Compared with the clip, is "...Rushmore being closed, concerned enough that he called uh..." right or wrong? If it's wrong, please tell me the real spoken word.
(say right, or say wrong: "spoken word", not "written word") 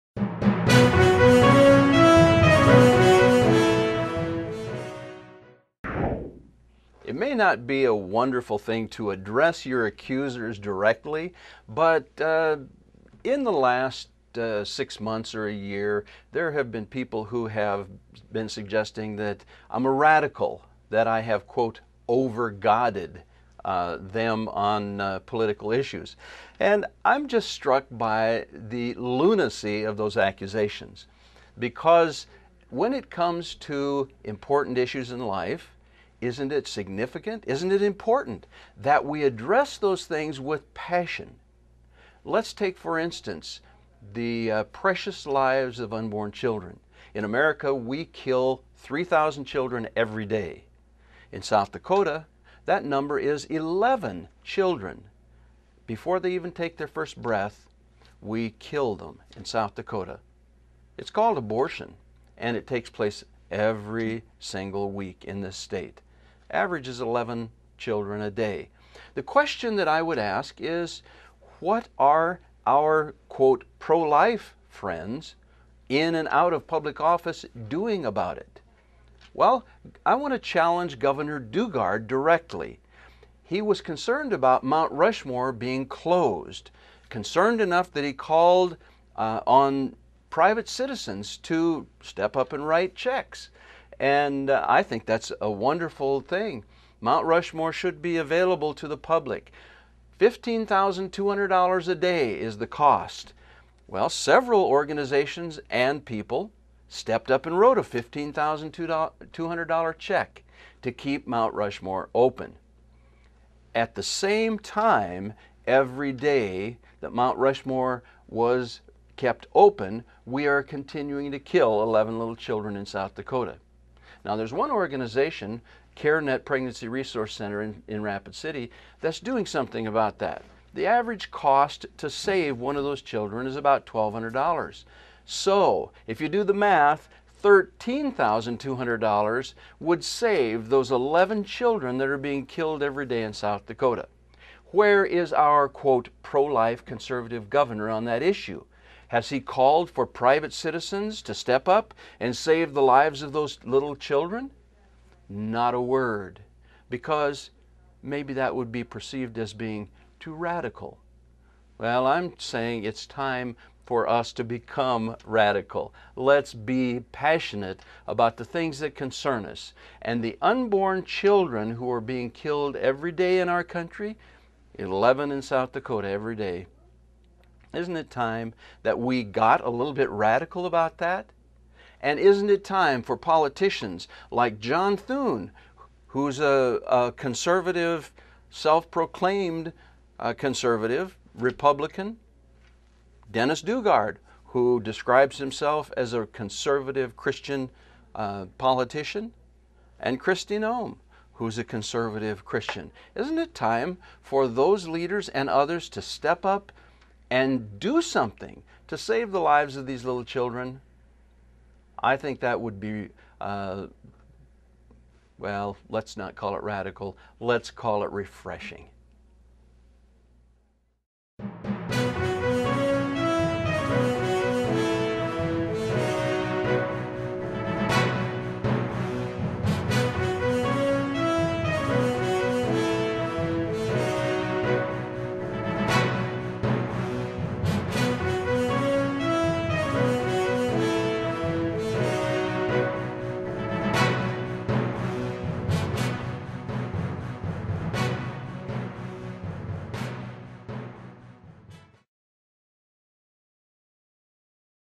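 right.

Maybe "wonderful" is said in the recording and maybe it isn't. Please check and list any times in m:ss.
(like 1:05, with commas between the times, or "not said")
0:07, 1:35.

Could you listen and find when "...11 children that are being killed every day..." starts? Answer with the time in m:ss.
2:20.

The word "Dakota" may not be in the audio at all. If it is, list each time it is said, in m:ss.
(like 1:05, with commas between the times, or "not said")
0:51, 0:59, 2:03, 2:23, 2:55.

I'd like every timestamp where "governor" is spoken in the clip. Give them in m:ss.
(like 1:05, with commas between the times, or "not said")
1:20, 2:27.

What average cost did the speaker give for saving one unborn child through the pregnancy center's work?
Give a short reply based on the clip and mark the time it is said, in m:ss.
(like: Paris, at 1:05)
$1,200, at 2:13.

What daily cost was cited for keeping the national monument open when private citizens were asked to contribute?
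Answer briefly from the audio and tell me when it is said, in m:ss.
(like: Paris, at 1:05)
$15,200, at 1:40.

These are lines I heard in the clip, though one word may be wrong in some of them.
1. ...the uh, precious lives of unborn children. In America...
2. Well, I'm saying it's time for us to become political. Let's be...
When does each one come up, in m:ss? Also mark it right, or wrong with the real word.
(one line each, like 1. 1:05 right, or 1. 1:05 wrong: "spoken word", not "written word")
1. 0:44 right
2. 2:41 wrong: "radical", not "political".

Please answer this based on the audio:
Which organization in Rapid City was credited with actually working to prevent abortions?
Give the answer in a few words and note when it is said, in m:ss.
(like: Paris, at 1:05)
CareNet Pregnancy Resource Center, at 2:05.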